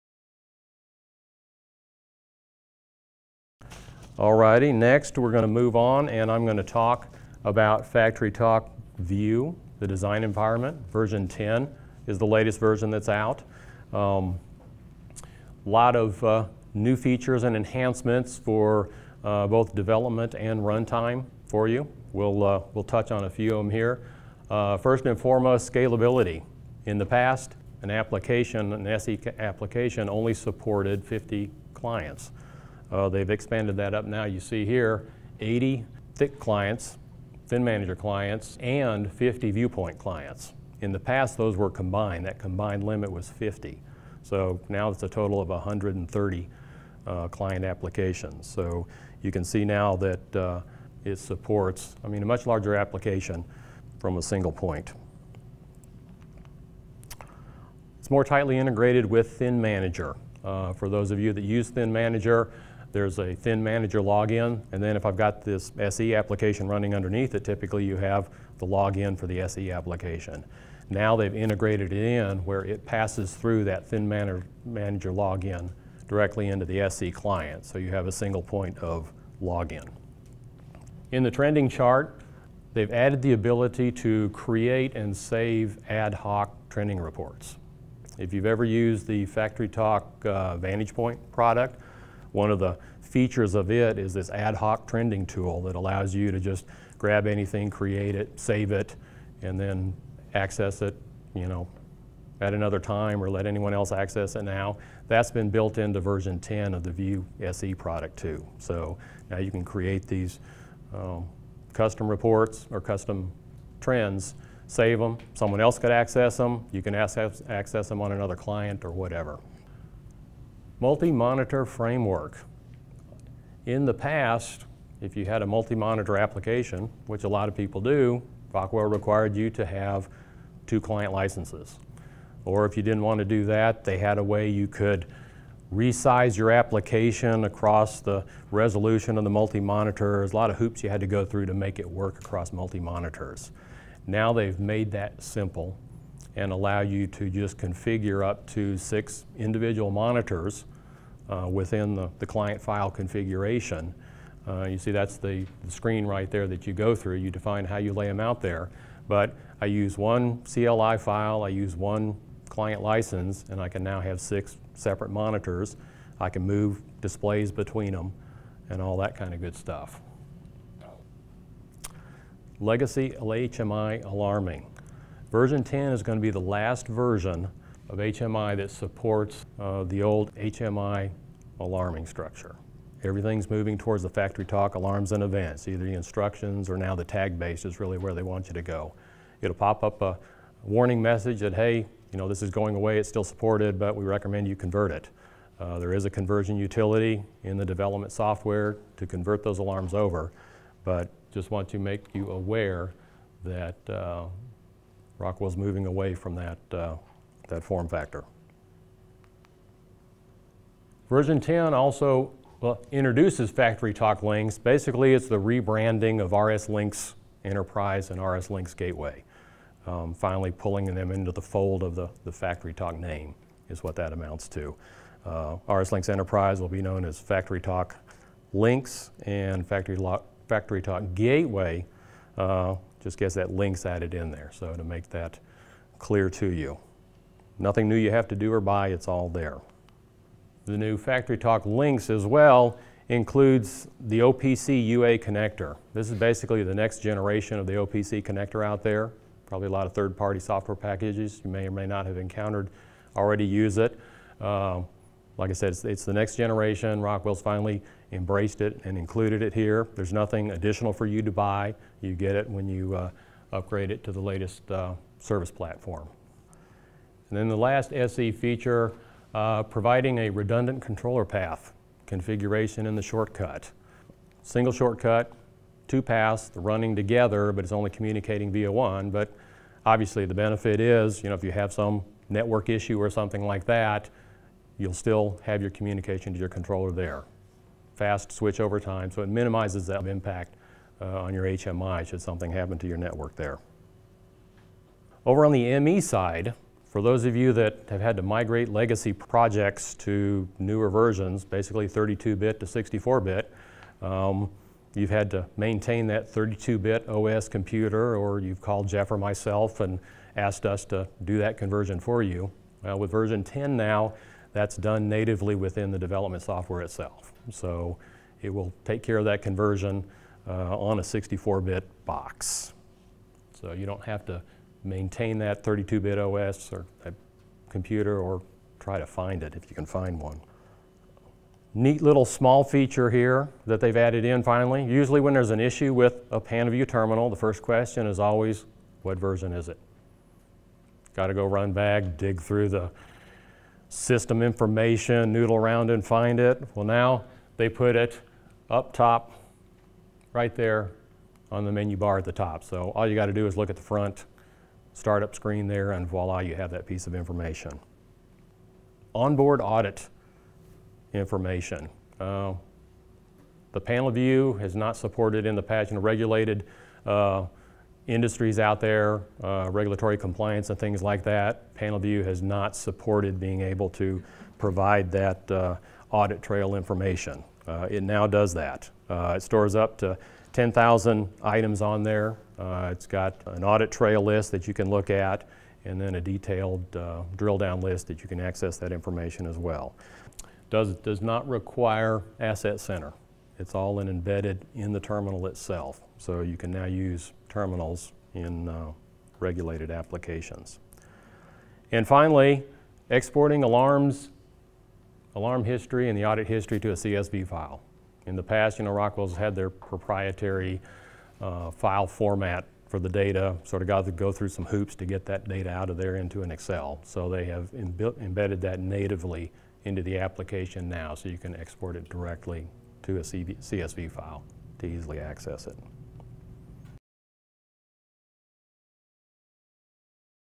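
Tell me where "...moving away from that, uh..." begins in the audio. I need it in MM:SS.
03:25.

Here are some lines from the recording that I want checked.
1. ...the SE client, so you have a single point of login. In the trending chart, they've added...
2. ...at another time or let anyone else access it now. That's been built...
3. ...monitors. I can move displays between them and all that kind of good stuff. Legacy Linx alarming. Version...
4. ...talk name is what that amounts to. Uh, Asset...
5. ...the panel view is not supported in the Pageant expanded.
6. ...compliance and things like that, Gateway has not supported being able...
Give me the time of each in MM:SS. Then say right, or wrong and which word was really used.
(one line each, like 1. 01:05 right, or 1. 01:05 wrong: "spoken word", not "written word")
1. 01:16 right
2. 01:42 right
3. 02:45 wrong: "LHMI", not "Linx"
4. 03:42 wrong: "RSLinx", not "Asset"
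5. 06:03 wrong: "regulated", not "expanded"
6. 06:10 wrong: "PanelView", not "Gateway".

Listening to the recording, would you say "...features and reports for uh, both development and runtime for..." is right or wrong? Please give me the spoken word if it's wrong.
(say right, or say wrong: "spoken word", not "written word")
wrong: "enhancements", not "reports".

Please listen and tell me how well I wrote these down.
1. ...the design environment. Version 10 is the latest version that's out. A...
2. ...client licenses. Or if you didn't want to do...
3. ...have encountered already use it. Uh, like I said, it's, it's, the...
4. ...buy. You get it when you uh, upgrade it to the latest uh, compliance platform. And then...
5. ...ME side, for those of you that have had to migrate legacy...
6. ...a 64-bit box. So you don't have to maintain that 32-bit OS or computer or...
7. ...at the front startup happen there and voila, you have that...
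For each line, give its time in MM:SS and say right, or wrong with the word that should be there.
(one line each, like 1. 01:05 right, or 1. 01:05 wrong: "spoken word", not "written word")
1. 00:09 right
2. 02:10 right
3. 04:12 right
4. 04:21 wrong: "service", not "compliance"
5. 04:55 right
6. 05:20 right
7. 05:53 wrong: "screen", not "happen".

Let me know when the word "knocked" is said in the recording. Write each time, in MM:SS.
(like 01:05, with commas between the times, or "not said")
not said.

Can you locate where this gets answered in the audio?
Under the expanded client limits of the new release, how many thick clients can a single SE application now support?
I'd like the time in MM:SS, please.
00:35.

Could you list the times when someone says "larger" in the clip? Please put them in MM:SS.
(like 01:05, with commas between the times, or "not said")
00:52.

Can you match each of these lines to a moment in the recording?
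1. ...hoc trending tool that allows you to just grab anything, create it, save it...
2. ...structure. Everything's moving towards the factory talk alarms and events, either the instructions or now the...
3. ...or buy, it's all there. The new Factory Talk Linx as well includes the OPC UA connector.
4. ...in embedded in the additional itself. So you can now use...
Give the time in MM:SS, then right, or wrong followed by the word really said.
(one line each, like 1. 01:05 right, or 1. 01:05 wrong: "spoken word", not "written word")
1. 01:34 right
2. 03:02 right
3. 03:58 right
4. 06:33 wrong: "terminal", not "additional".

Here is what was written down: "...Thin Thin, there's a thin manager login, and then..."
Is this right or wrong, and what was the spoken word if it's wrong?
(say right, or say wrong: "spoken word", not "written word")
wrong: "Manager", not "Thin".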